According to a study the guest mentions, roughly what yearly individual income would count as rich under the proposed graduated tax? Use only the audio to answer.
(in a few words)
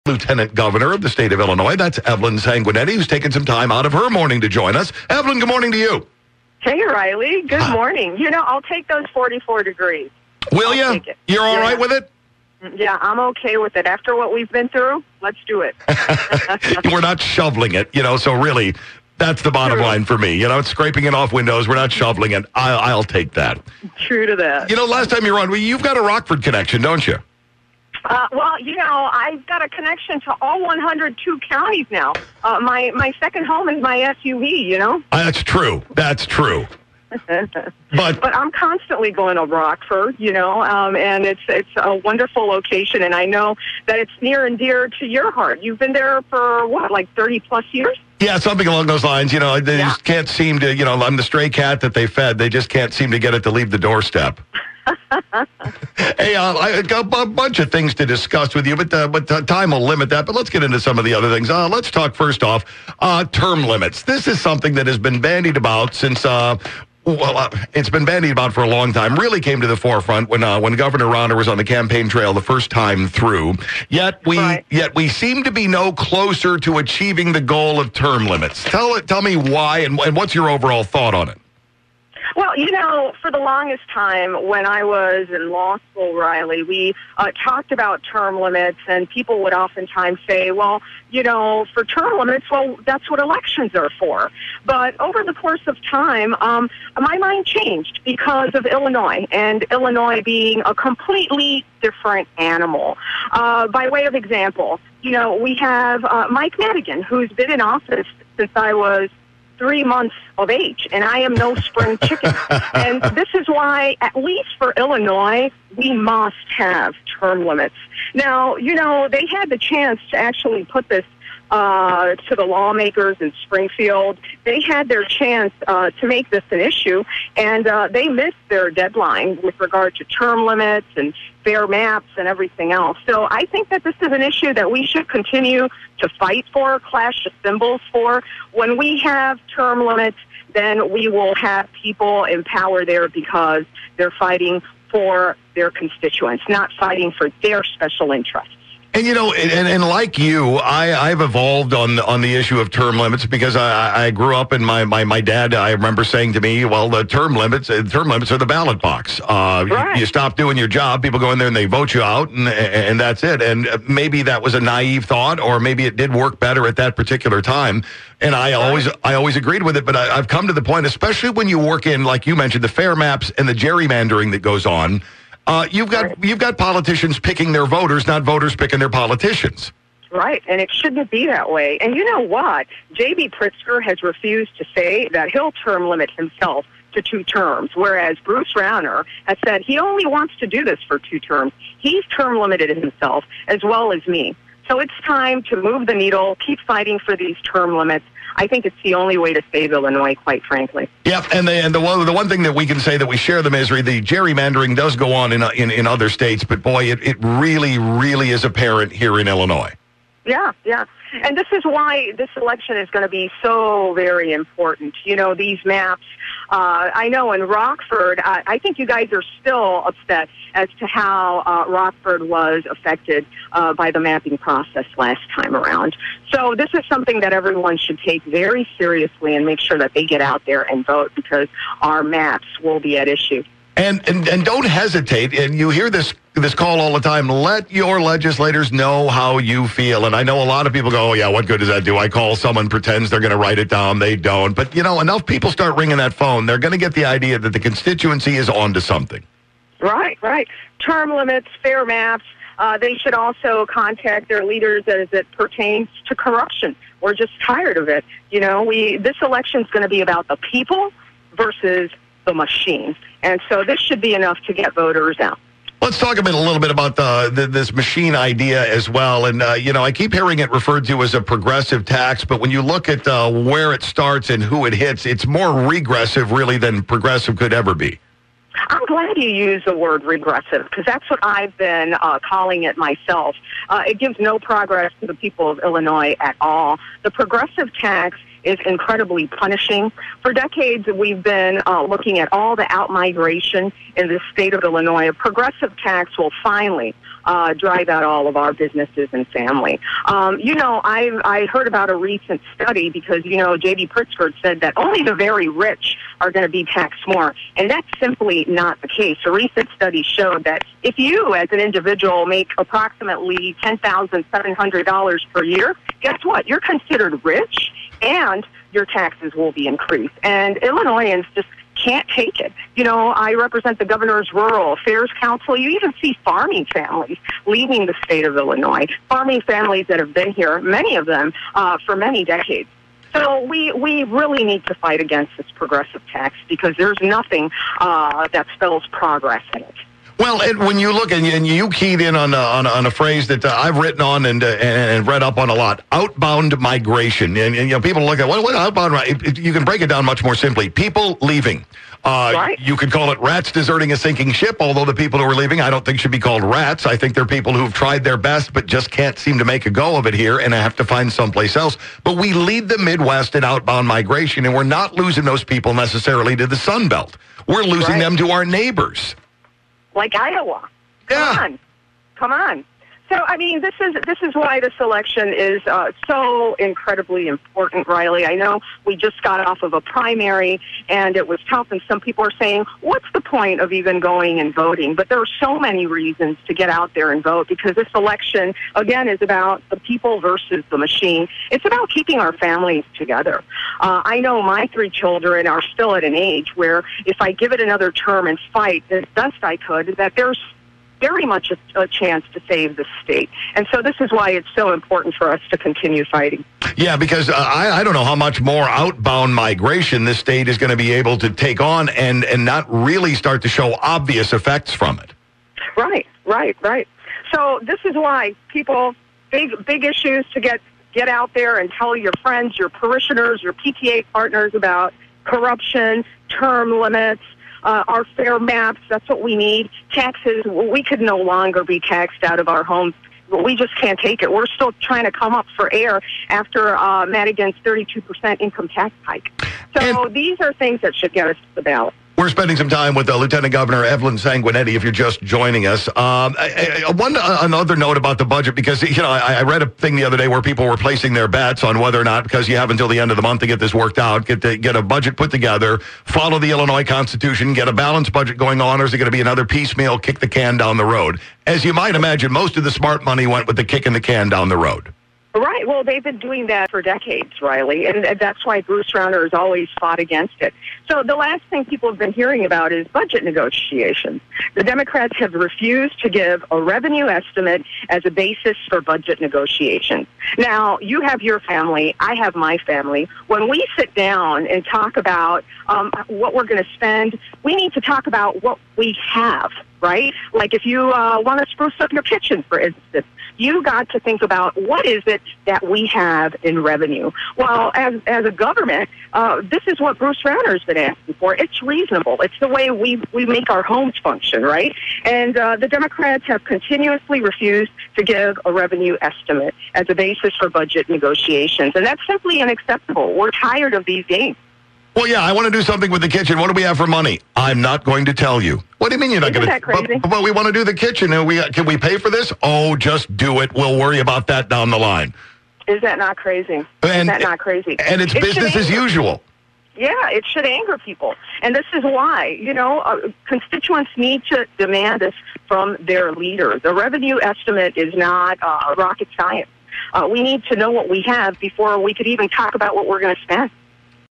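$10,700.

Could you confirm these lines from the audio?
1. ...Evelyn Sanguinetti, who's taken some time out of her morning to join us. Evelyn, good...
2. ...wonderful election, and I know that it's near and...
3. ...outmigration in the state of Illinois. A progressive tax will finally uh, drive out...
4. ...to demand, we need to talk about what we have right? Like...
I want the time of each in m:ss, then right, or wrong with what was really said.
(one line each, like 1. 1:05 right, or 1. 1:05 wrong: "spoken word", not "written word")
1. 0:01 right
2. 0:41 wrong: "location", not "election"
3. 4:52 right
4. 8:06 wrong: "spend", not "demand".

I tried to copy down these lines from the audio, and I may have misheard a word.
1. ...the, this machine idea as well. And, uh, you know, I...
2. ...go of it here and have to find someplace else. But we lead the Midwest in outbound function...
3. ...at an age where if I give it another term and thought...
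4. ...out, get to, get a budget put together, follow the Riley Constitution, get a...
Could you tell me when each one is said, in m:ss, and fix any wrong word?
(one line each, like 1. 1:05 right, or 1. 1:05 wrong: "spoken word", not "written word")
1. 4:27 right
2. 5:59 wrong: "migration", not "function"
3. 6:35 wrong: "fight", not "thought"
4. 7:33 wrong: "Illinois", not "Riley".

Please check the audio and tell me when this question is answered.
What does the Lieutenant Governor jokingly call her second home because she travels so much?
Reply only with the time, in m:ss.
0:33.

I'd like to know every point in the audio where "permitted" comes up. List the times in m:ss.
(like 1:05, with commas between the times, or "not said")
not said.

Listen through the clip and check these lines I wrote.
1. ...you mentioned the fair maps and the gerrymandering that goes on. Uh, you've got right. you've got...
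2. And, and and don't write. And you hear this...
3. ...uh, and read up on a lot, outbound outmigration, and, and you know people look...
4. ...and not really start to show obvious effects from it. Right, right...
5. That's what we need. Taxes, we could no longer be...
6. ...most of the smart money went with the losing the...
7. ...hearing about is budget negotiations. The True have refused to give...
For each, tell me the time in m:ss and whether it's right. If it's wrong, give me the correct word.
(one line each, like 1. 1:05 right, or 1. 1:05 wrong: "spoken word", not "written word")
1. 2:52 right
2. 3:53 wrong: "hesitate", not "write"
3. 5:44 wrong: "migration", not "outmigration"
4. 6:52 right
5. 7:08 right
6. 7:42 wrong: "kicking", not "losing"
7. 7:52 wrong: "Democrats", not "True".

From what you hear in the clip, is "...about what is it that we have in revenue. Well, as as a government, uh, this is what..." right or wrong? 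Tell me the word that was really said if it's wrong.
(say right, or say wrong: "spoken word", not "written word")
right.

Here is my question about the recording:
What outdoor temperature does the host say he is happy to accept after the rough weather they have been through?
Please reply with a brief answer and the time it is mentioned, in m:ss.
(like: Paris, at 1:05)
44 degrees, at 0:09.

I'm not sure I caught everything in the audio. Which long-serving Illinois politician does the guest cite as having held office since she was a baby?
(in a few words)
Mike Madigan.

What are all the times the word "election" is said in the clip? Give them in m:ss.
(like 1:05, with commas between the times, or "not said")
1:33, 3:32, 4:19, 6:14, 6:27.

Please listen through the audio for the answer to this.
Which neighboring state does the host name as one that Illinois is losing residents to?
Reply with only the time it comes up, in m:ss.
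6:10.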